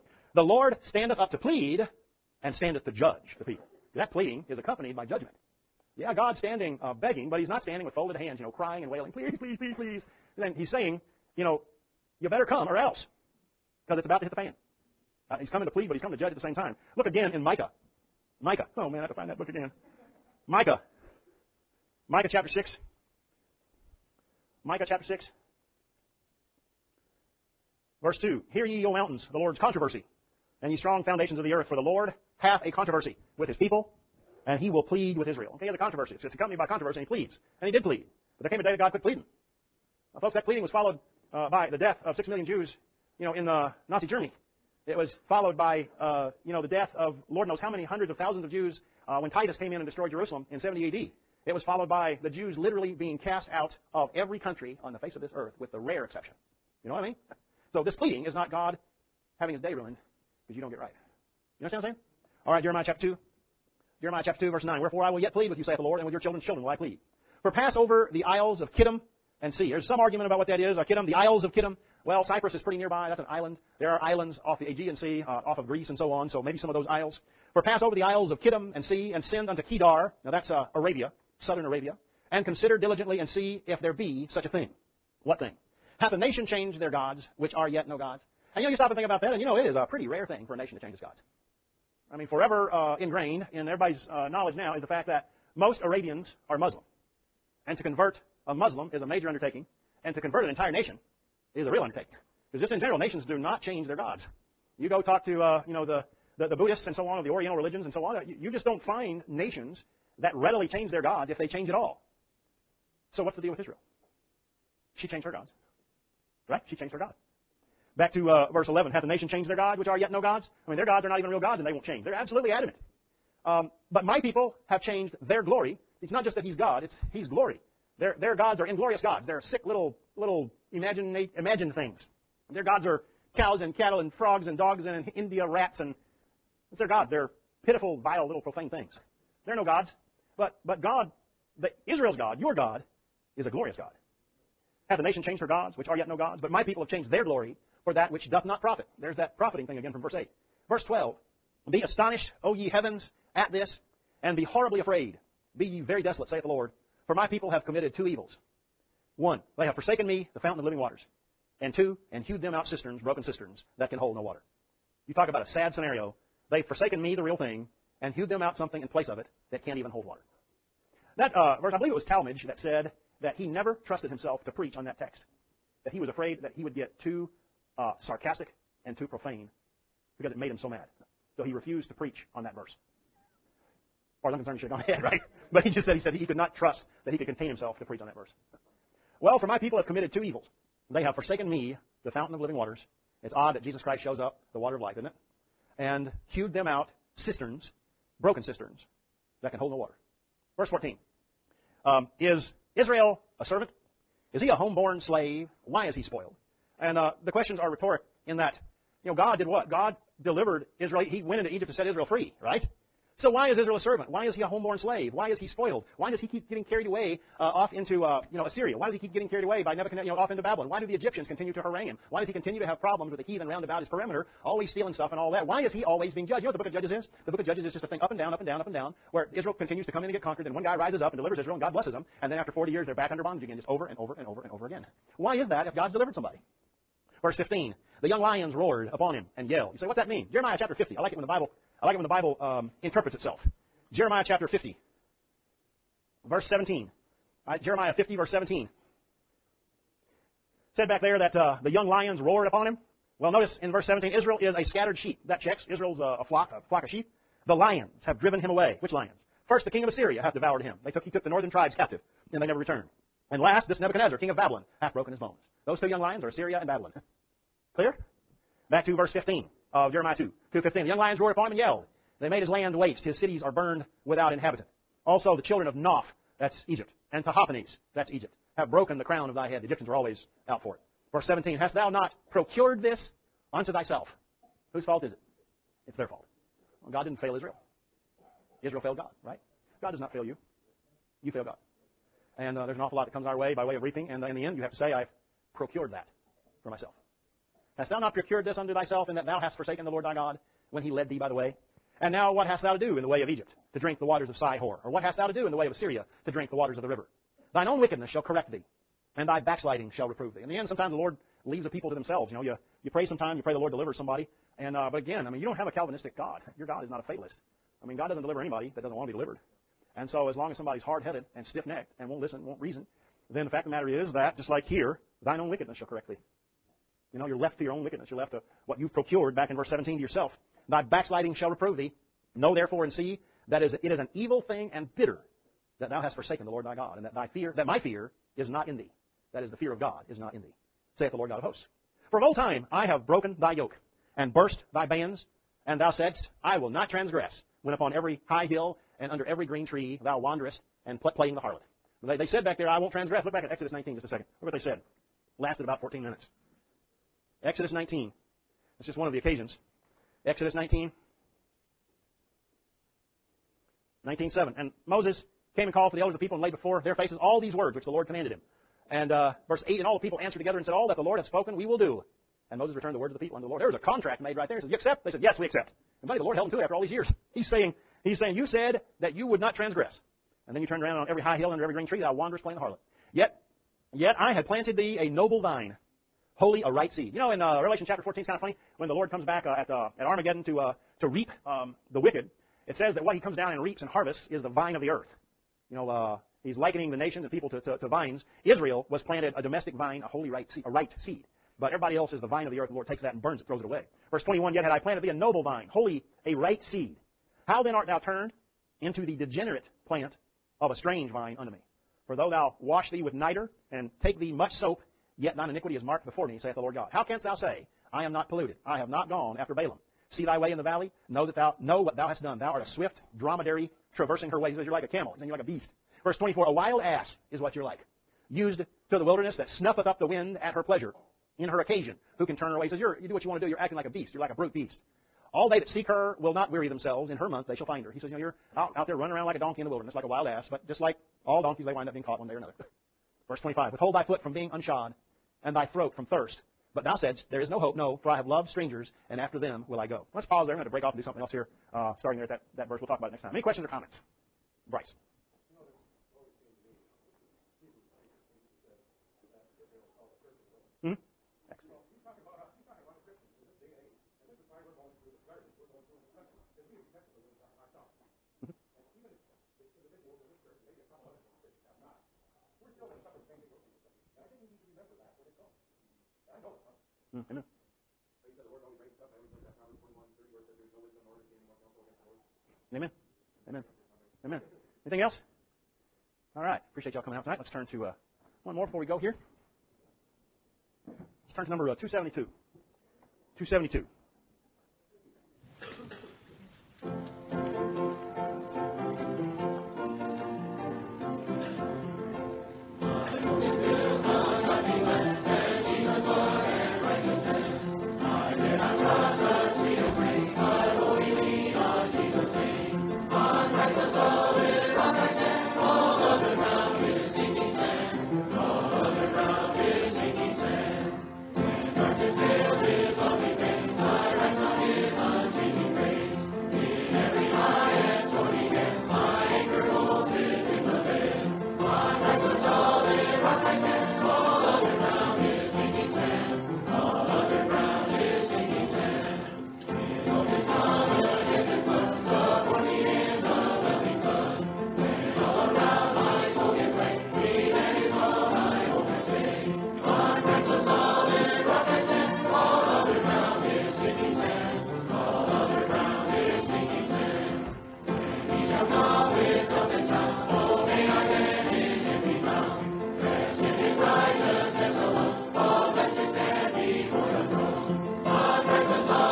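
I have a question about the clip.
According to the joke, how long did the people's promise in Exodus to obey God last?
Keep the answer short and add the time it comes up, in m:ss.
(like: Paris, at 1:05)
14 minutes, at 5:55.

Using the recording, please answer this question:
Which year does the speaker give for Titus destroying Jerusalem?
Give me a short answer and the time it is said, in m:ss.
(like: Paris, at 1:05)
70 AD, at 0:50.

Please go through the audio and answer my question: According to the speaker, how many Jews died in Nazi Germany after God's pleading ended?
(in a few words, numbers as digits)
6 million.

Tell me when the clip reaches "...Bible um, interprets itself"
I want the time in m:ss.
4:02.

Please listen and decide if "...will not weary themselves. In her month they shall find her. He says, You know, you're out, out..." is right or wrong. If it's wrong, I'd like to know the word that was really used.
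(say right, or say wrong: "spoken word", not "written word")
right.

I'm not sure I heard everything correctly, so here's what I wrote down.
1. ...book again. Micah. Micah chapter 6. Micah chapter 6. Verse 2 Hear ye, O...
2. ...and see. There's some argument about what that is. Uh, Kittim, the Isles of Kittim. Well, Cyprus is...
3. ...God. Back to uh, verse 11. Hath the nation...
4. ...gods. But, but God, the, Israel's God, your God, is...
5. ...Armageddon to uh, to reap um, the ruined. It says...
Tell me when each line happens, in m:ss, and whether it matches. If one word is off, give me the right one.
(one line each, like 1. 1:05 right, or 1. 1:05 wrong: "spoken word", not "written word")
1. 0:19 right
2. 1:09 right
3. 1:56 right
4. 2:19 right
5. 6:30 wrong: "wicked", not "ruined".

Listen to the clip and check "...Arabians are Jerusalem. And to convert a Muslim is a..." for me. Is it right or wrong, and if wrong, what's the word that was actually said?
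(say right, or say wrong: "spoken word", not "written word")
wrong: "Muslim", not "Jerusalem".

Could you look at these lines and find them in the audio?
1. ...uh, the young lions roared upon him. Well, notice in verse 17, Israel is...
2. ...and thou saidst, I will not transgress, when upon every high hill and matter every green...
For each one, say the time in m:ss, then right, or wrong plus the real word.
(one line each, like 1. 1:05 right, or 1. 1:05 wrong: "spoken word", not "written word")
1. 4:11 right
2. 5:45 wrong: "under", not "matter".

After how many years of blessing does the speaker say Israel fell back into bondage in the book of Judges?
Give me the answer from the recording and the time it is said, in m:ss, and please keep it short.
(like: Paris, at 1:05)
40 years, at 3:52.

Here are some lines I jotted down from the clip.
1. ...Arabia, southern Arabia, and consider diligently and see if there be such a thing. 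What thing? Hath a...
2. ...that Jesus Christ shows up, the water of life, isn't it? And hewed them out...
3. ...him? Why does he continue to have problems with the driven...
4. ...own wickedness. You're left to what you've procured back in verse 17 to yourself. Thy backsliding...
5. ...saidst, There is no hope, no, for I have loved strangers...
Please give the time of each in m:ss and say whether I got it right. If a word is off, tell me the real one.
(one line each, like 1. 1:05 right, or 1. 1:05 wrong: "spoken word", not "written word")
1. 1:20 right
2. 3:13 right
3. 3:41 wrong: "heathen", not "driven"
4. 5:27 right
5. 7:27 right.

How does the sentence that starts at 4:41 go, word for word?
Verse 17, Hast thou not procured this unto thyself?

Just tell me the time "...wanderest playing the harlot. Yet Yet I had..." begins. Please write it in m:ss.
6:22.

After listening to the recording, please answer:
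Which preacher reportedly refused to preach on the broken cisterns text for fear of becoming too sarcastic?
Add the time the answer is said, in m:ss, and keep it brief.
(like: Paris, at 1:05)
Talmage, at 2:52.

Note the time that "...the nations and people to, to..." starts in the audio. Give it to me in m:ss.
6:36.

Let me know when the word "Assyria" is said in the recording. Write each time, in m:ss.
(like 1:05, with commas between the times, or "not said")
3:38, 4:19, 4:26, 5:05.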